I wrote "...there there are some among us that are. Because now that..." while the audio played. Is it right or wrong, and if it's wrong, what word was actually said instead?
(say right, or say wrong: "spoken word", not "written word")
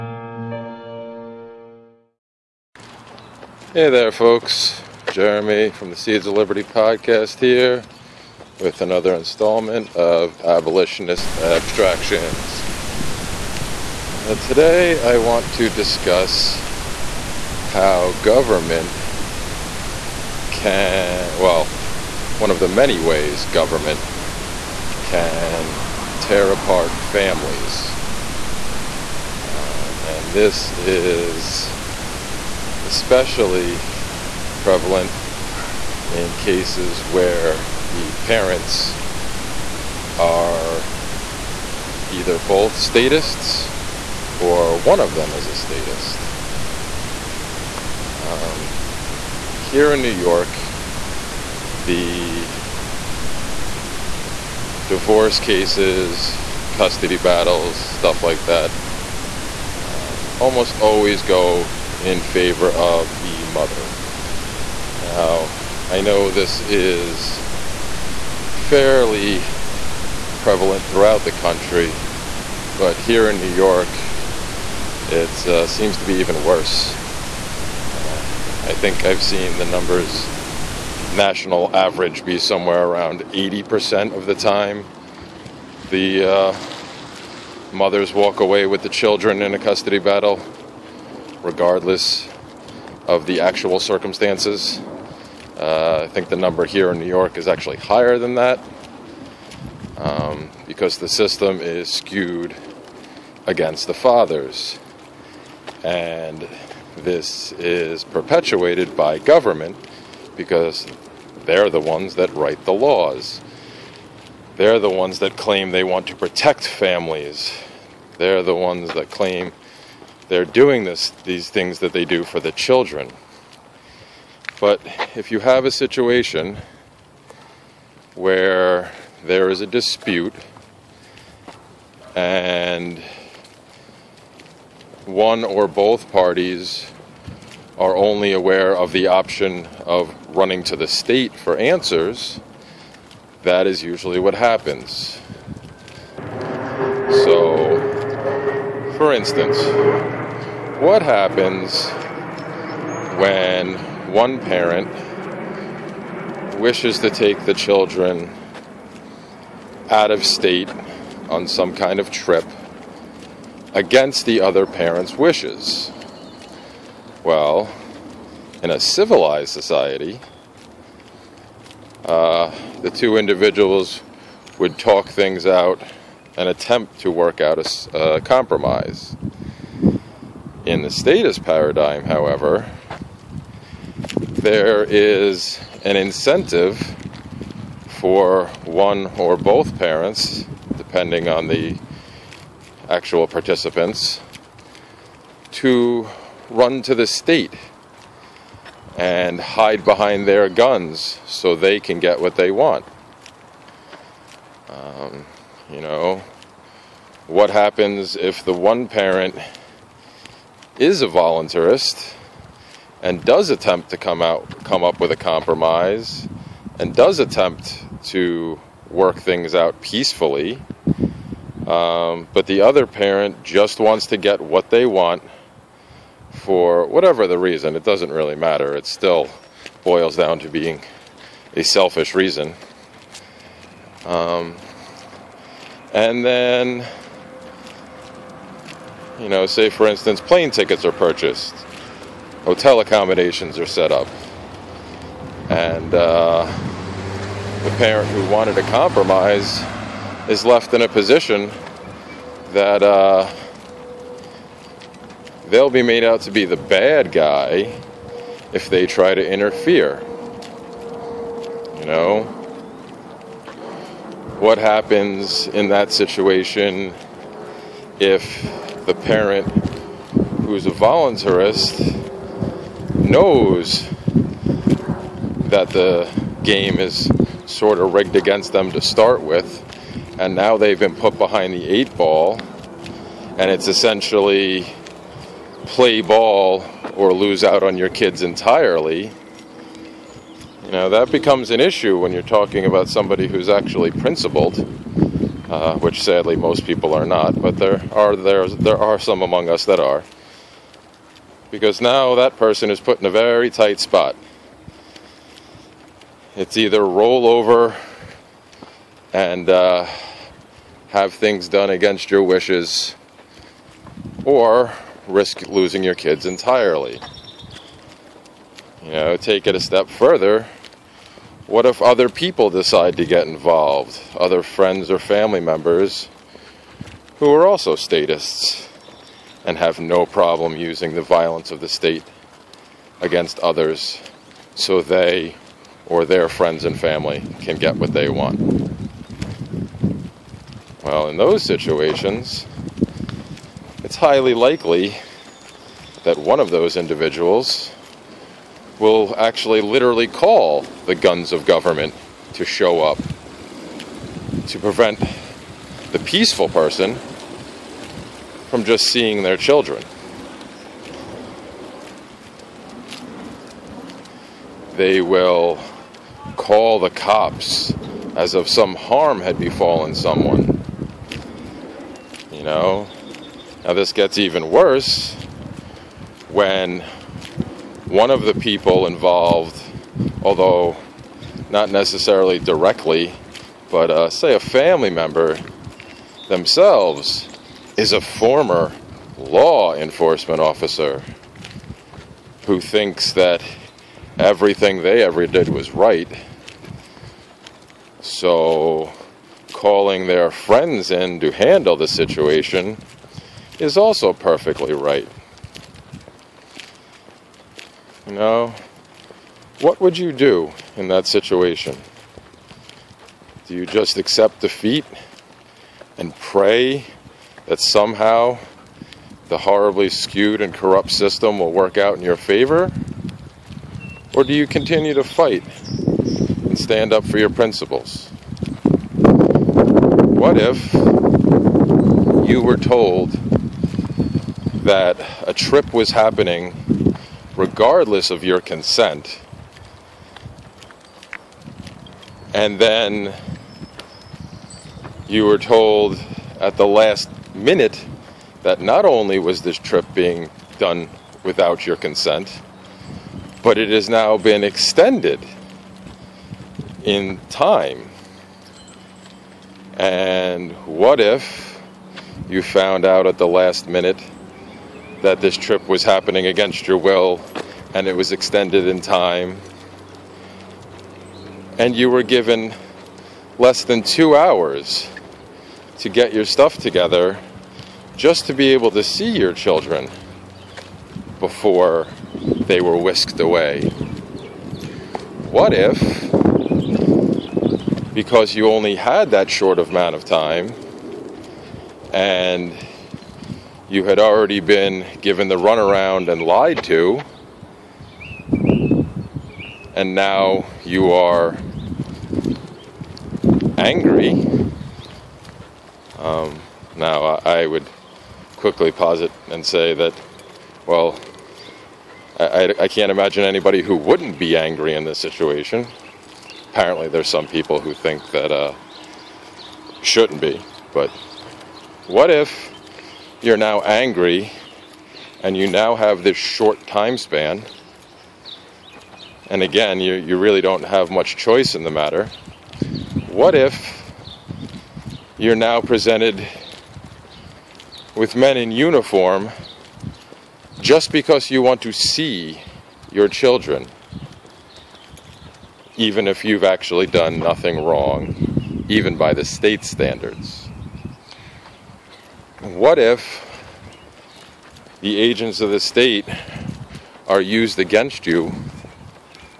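right.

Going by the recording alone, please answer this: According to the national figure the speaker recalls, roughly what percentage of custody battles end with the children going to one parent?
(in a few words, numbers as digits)
80%.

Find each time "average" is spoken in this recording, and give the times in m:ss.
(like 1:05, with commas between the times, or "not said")
1:21.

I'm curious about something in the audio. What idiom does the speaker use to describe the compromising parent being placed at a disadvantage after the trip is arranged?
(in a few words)
behind the eight ball.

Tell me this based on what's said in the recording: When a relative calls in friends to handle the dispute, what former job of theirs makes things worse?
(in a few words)
law enforcement officer.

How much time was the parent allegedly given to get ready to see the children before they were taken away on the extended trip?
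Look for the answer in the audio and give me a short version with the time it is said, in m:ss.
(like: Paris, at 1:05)
less than 2 hours, at 7:53.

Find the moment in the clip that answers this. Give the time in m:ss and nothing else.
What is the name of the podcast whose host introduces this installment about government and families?
0:05.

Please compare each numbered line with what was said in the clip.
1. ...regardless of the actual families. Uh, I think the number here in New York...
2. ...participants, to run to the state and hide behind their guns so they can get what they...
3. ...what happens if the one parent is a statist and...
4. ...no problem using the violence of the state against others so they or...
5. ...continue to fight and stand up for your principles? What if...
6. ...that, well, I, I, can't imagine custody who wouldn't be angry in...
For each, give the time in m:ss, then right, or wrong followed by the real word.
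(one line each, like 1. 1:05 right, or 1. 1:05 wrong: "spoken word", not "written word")
1. 1:31 wrong: "circumstances", not "families"
2. 3:13 right
3. 3:27 wrong: "voluntarist", not "statist"
4. 5:29 right
5. 7:04 right
6. 8:29 wrong: "anybody", not "custody".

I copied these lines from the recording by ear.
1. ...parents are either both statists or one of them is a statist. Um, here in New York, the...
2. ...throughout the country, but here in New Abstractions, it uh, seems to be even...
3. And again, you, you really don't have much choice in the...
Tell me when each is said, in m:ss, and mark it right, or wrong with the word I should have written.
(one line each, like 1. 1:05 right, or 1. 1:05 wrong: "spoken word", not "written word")
1. 0:38 right
2. 1:10 wrong: "York", not "Abstractions"
3. 8:49 right.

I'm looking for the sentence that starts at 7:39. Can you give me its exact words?
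And what if you found out at the last minute?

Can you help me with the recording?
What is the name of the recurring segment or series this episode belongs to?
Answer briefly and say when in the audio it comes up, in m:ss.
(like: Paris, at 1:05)
Abolitionist Abstractions, at 0:10.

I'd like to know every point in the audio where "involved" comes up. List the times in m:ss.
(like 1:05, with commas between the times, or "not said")
5:23, 6:18.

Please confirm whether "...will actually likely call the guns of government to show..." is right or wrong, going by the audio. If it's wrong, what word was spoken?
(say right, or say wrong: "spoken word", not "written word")
wrong: "literally", not "likely".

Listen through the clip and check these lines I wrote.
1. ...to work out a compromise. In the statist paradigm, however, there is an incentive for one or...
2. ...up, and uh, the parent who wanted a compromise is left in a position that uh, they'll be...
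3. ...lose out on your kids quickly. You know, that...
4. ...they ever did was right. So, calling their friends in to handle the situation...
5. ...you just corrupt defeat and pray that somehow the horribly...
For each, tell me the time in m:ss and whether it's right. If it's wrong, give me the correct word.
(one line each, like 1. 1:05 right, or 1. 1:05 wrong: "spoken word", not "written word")
1. 2:57 right
2. 4:03 right
3. 4:47 wrong: "entirely", not "quickly"
4. 6:34 right
5. 6:53 wrong: "accept", not "corrupt".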